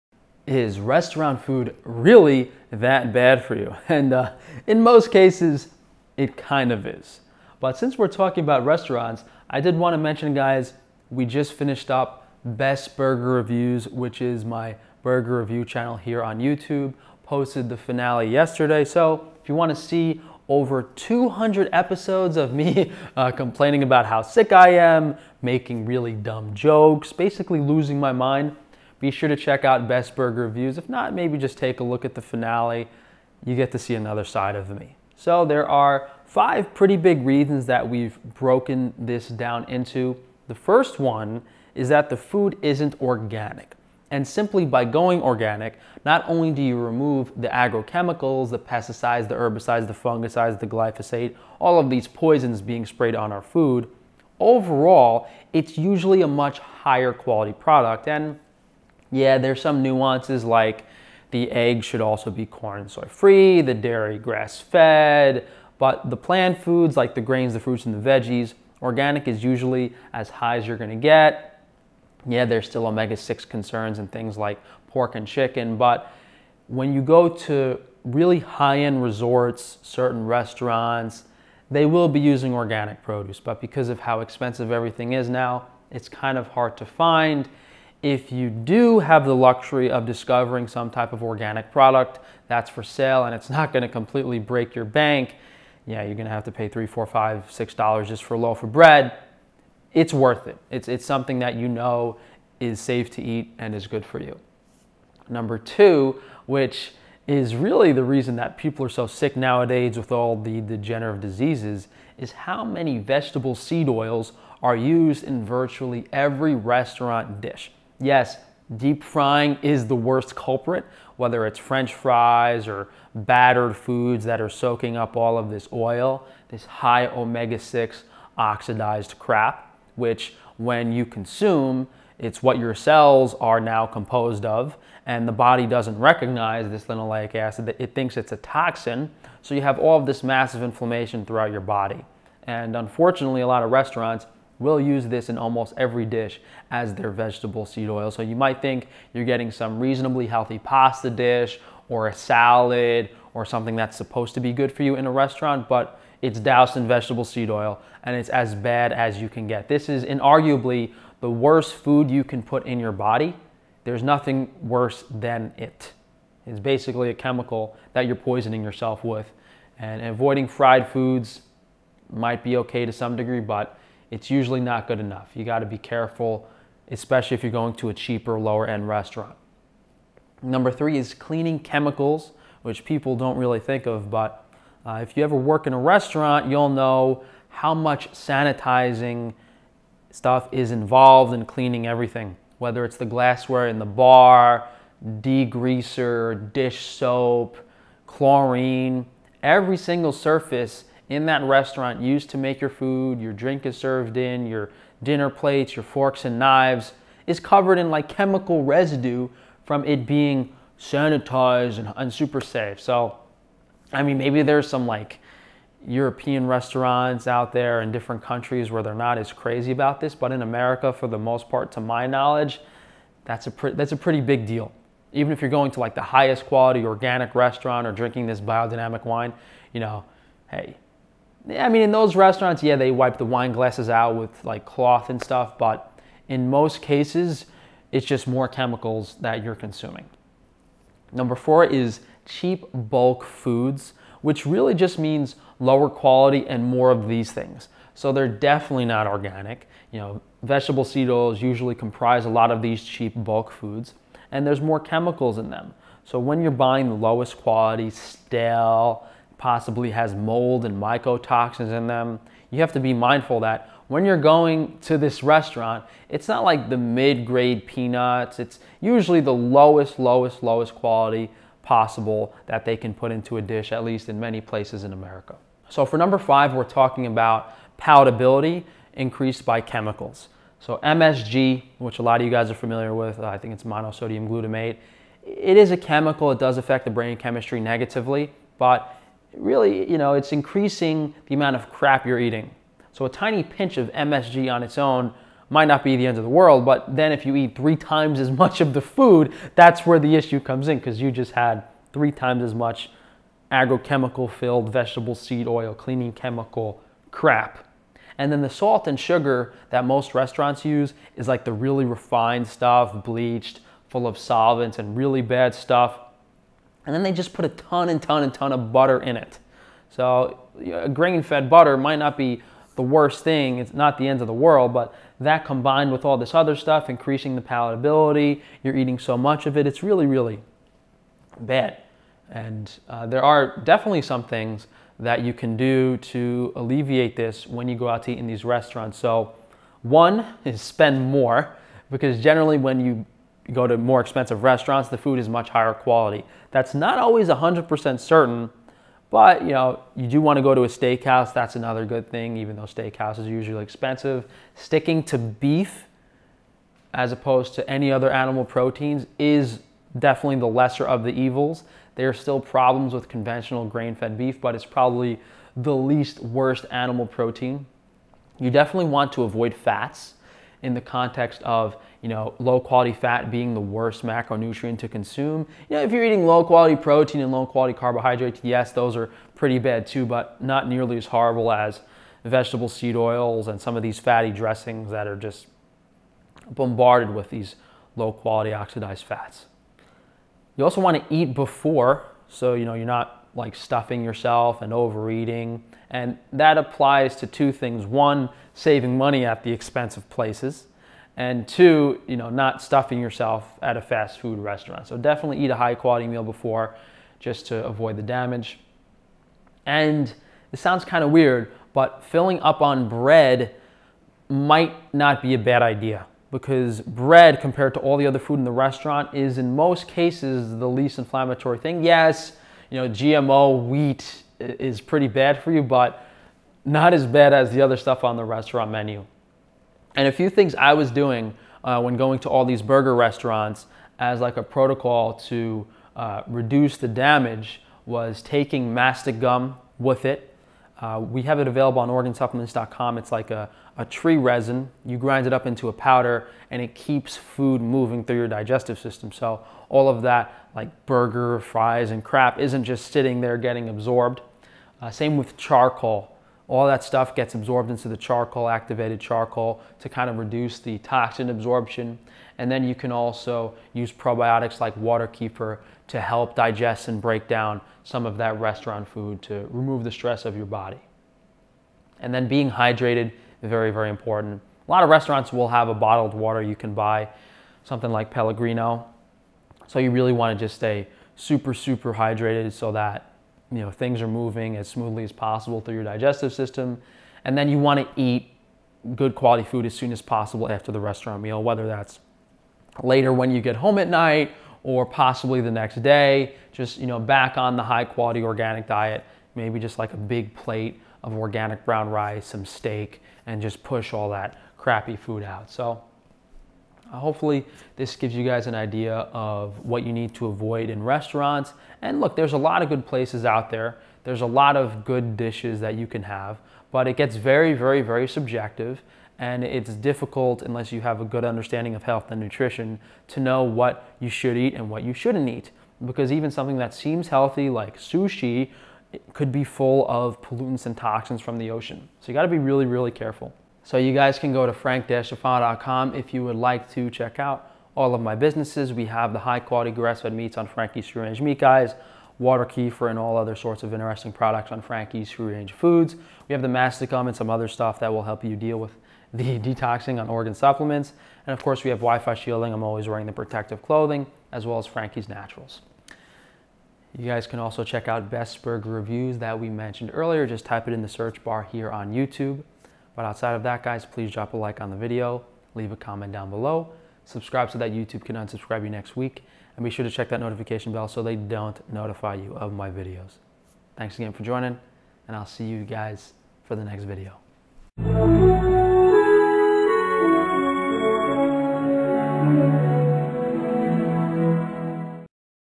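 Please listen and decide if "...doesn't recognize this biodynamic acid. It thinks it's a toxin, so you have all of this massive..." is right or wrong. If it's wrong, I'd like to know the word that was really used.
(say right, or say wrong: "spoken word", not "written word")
wrong: "linoleic", not "biodynamic".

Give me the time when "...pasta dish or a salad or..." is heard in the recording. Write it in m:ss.
2:30.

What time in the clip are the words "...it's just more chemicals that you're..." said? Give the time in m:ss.
3:57.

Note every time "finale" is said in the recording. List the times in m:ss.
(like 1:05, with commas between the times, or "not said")
0:17, 0:32.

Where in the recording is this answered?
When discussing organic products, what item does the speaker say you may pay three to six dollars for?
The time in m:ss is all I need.
1:38.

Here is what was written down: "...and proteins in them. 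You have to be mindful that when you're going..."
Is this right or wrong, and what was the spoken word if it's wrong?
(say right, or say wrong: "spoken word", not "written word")
wrong: "mycotoxins", not "proteins".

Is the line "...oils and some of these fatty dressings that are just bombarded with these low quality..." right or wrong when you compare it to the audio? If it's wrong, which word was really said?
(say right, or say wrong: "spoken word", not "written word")
right.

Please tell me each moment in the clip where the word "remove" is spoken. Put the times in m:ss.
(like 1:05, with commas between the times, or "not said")
0:46, 7:49.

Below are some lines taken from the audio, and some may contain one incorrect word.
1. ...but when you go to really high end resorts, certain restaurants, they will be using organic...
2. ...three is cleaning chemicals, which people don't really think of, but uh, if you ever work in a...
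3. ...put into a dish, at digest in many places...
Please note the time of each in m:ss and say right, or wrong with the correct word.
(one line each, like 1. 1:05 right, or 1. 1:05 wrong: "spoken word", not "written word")
1. 1:15 right
2. 3:00 right
3. 4:32 wrong: "least", not "digest".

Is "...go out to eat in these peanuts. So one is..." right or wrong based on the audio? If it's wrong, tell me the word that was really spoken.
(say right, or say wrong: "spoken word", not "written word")
wrong: "restaurants", not "peanuts".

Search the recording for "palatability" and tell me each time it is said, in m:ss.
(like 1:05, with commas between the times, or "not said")
4:37, 5:27.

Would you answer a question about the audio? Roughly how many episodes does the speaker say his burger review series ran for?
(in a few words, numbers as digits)
over 200.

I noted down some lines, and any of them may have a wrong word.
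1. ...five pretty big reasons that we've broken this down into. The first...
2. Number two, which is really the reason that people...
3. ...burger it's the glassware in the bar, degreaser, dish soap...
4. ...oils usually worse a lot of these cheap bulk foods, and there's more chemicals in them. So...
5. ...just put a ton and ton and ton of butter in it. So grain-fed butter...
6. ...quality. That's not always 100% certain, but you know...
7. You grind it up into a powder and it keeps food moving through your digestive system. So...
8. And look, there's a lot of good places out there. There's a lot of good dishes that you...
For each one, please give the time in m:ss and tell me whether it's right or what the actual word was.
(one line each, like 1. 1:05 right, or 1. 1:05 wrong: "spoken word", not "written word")
1. 0:36 right
2. 1:45 right
3. 3:12 wrong: "whether", not "burger"
4. 4:11 wrong: "comprise", not "worse"
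5. 5:17 right
6. 5:45 right
7. 7:24 right
8. 8:31 right.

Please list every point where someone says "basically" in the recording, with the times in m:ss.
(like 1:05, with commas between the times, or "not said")
0:27, 2:46.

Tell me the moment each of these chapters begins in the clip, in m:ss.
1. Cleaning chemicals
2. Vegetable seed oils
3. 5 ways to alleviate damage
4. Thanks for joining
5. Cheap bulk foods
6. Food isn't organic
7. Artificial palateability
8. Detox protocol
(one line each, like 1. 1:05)
1. 2:59
2. 1:44
3. 5:32
4. 8:53
5. 4:00
6. 0:40
7. 4:35
8. 7:09.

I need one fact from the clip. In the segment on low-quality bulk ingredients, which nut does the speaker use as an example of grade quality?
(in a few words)
peanuts.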